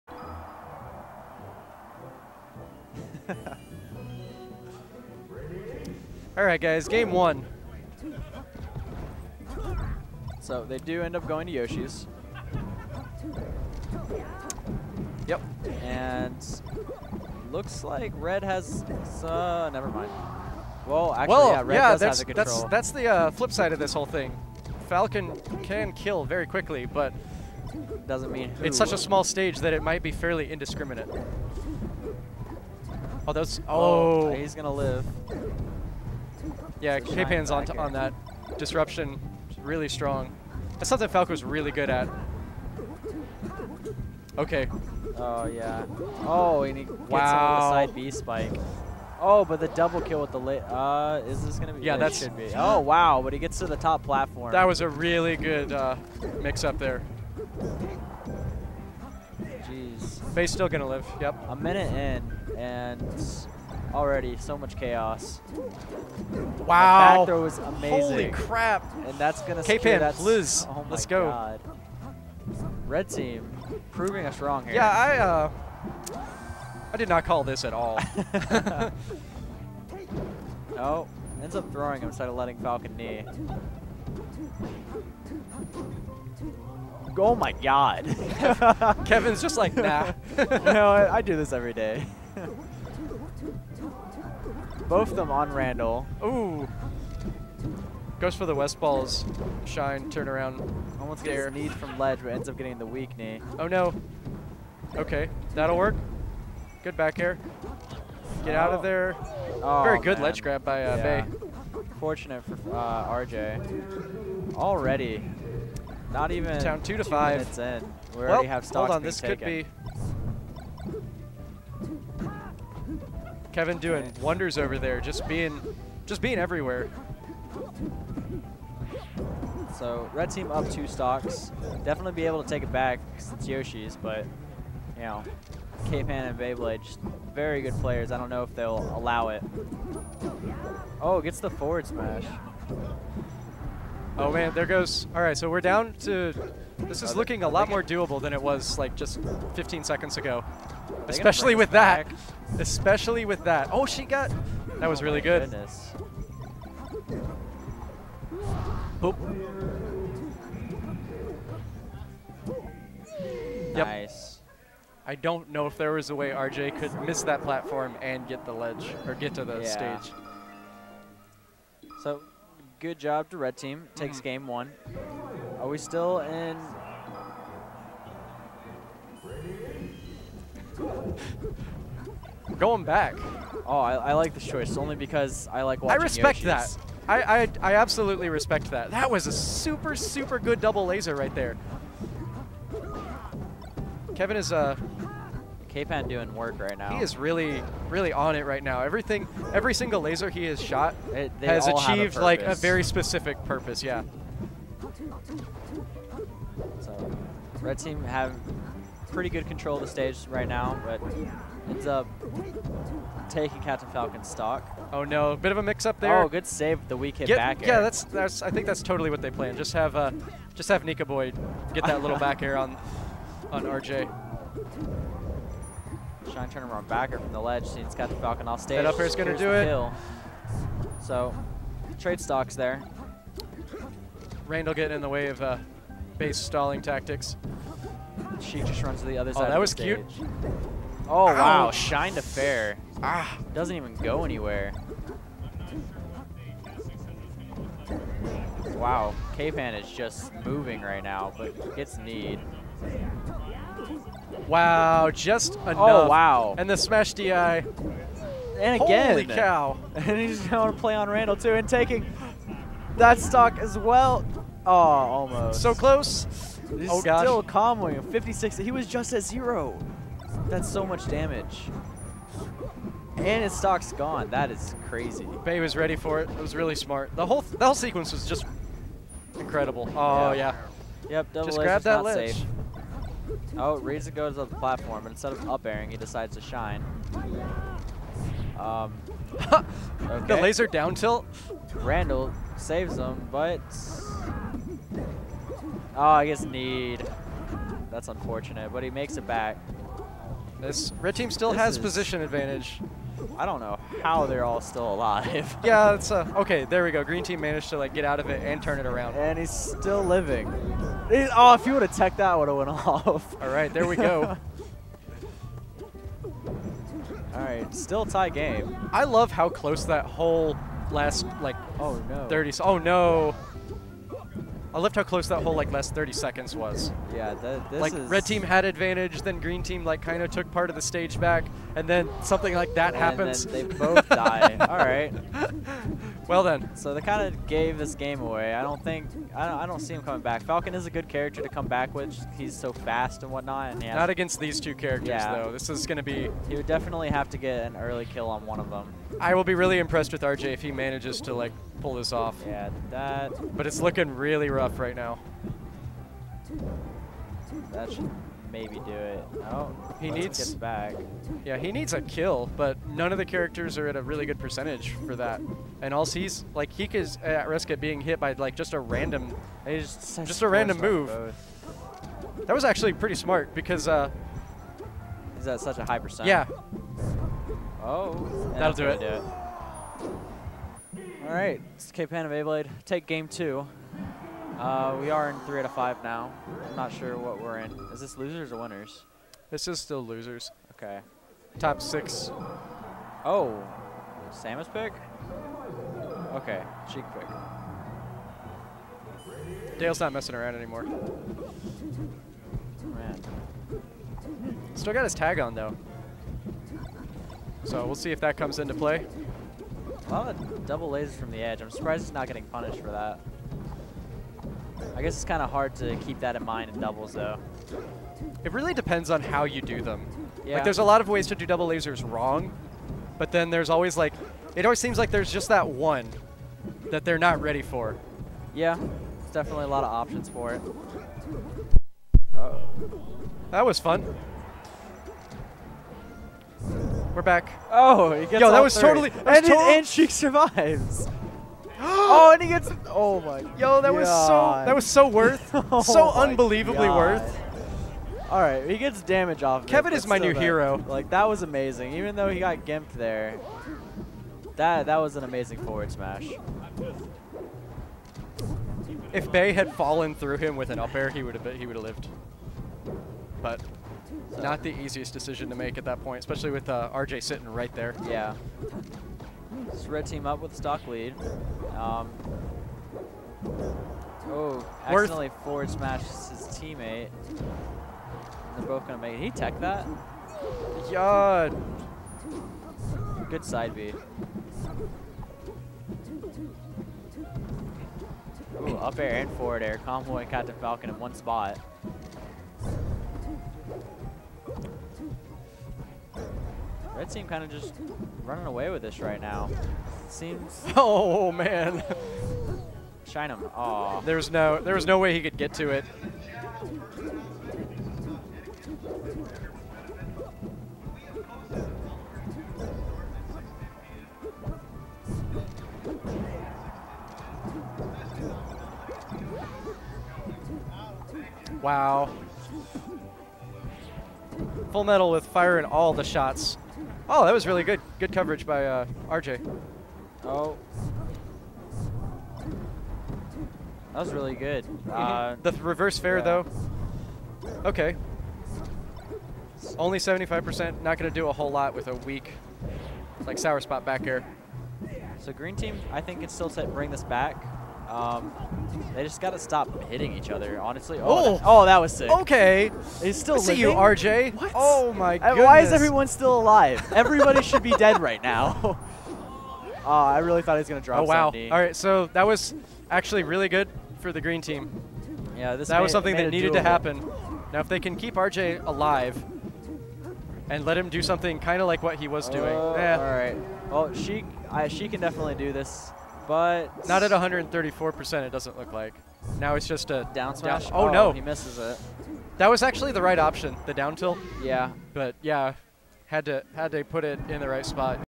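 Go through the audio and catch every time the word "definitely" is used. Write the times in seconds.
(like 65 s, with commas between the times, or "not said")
131 s, 346 s, 429 s, 575 s.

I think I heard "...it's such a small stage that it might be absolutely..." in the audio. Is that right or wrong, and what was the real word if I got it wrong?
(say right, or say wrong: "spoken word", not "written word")
wrong: "fairly", not "absolutely".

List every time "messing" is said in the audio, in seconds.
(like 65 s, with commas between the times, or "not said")
400 s.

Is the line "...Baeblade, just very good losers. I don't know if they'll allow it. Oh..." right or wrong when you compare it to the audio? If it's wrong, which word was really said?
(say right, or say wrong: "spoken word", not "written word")
wrong: "players", not "losers".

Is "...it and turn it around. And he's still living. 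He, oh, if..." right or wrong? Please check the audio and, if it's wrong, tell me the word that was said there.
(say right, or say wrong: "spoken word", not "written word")
right.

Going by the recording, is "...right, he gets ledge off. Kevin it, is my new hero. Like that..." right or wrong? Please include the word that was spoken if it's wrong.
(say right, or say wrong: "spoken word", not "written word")
wrong: "damage", not "ledge".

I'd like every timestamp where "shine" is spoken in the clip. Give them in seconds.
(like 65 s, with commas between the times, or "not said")
99 s, 226 s, 241 s, 286 s, 503 s.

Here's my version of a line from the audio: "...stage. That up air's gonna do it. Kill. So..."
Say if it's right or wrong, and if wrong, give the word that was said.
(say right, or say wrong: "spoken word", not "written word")
right.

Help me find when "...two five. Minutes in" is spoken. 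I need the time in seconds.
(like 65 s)
117 s.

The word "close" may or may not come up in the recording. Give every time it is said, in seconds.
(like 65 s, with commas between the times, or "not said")
265 s, 319 s, 325 s.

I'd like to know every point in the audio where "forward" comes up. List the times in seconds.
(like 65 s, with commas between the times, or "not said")
141 s, 455 s, 475 s, 489 s.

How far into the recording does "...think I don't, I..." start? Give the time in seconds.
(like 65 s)
338 s.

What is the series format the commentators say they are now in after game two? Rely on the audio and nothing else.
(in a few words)
three out of five.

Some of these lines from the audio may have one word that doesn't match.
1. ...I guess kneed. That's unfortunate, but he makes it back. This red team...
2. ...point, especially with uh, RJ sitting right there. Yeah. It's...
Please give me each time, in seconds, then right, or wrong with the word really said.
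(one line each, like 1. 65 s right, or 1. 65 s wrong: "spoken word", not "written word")
1. 296 s right
2. 466 s right.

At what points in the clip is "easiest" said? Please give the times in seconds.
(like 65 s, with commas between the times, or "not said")
464 s.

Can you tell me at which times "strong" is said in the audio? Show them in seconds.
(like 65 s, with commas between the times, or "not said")
39 s.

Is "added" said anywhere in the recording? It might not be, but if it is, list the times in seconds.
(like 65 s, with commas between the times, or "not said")
not said.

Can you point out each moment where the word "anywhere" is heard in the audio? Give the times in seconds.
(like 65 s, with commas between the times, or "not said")
244 s.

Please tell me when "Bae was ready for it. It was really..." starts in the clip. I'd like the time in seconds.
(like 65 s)
275 s.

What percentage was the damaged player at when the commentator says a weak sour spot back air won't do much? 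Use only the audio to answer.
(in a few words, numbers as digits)
75%.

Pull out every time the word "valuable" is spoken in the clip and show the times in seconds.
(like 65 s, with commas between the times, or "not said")
not said.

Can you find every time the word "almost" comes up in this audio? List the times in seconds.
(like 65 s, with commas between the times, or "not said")
100 s, 264 s.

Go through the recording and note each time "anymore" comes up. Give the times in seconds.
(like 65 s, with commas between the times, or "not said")
400 s.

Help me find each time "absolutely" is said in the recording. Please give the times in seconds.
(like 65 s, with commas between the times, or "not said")
187 s.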